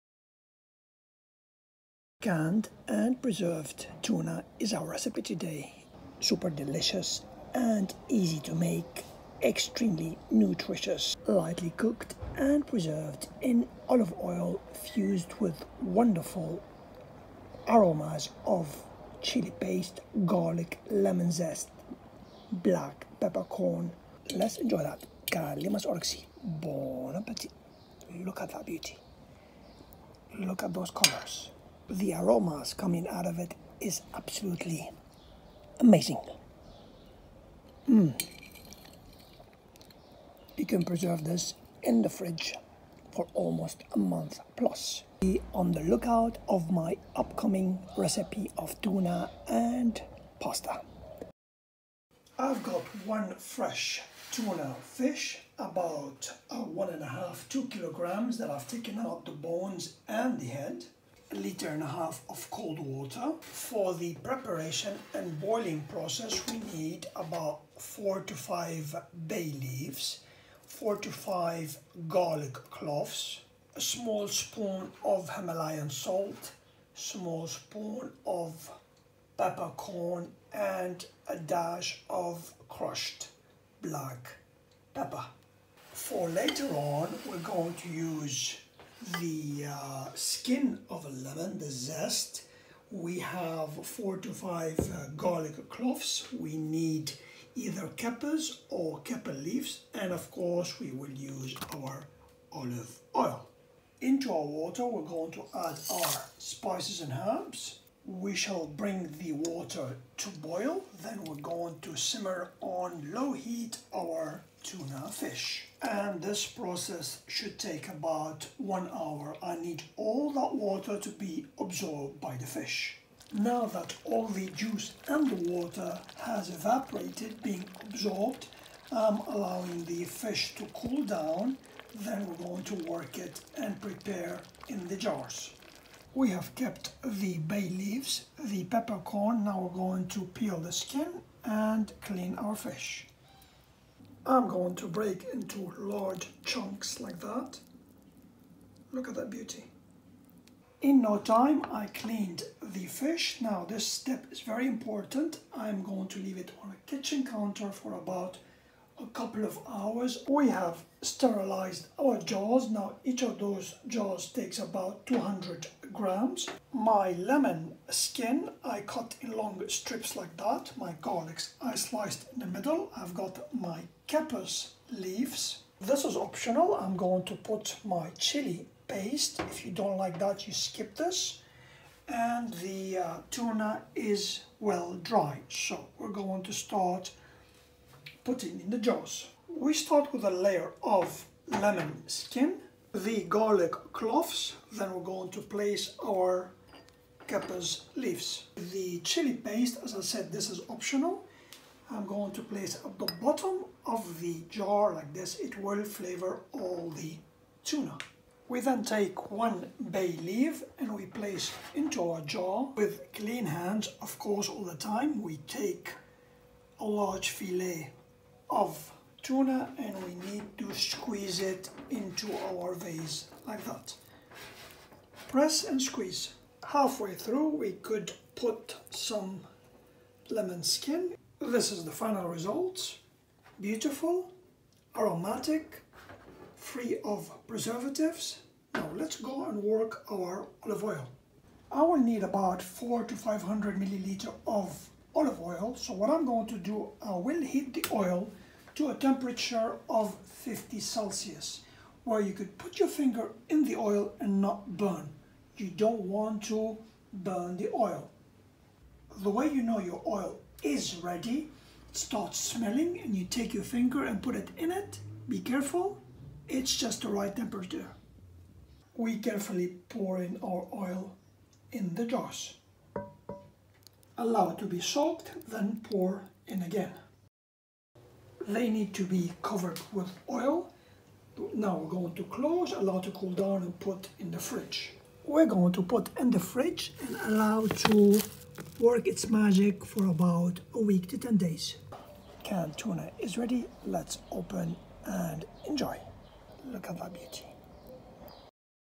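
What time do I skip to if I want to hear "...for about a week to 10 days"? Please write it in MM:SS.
04:49.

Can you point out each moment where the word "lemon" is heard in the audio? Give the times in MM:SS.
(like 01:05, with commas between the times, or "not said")
00:20, 01:31, 02:47, 03:11, 03:50.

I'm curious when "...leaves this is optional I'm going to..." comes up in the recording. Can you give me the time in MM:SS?
02:54.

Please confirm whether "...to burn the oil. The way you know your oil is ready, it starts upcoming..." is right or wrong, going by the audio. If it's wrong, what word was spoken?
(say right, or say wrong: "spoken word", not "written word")
wrong: "smelling", not "upcoming".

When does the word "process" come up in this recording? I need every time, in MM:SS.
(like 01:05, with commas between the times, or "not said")
01:05, 01:56.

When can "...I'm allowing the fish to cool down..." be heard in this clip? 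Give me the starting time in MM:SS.
02:08.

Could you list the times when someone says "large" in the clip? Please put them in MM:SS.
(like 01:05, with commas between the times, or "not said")
02:25, 03:36.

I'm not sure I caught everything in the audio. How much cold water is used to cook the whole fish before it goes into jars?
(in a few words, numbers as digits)
1.5 liters.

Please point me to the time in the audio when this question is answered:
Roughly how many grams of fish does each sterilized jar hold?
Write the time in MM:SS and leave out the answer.
02:45.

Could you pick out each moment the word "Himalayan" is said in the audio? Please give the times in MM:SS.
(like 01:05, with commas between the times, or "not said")
01:15.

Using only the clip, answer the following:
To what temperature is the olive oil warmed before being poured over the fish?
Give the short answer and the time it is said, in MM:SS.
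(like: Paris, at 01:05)
50 Celsius, at 04:10.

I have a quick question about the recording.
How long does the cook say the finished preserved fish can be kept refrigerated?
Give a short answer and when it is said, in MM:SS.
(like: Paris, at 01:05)
almost a month plus, at 00:43.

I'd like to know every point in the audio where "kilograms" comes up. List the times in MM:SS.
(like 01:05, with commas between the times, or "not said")
00:57.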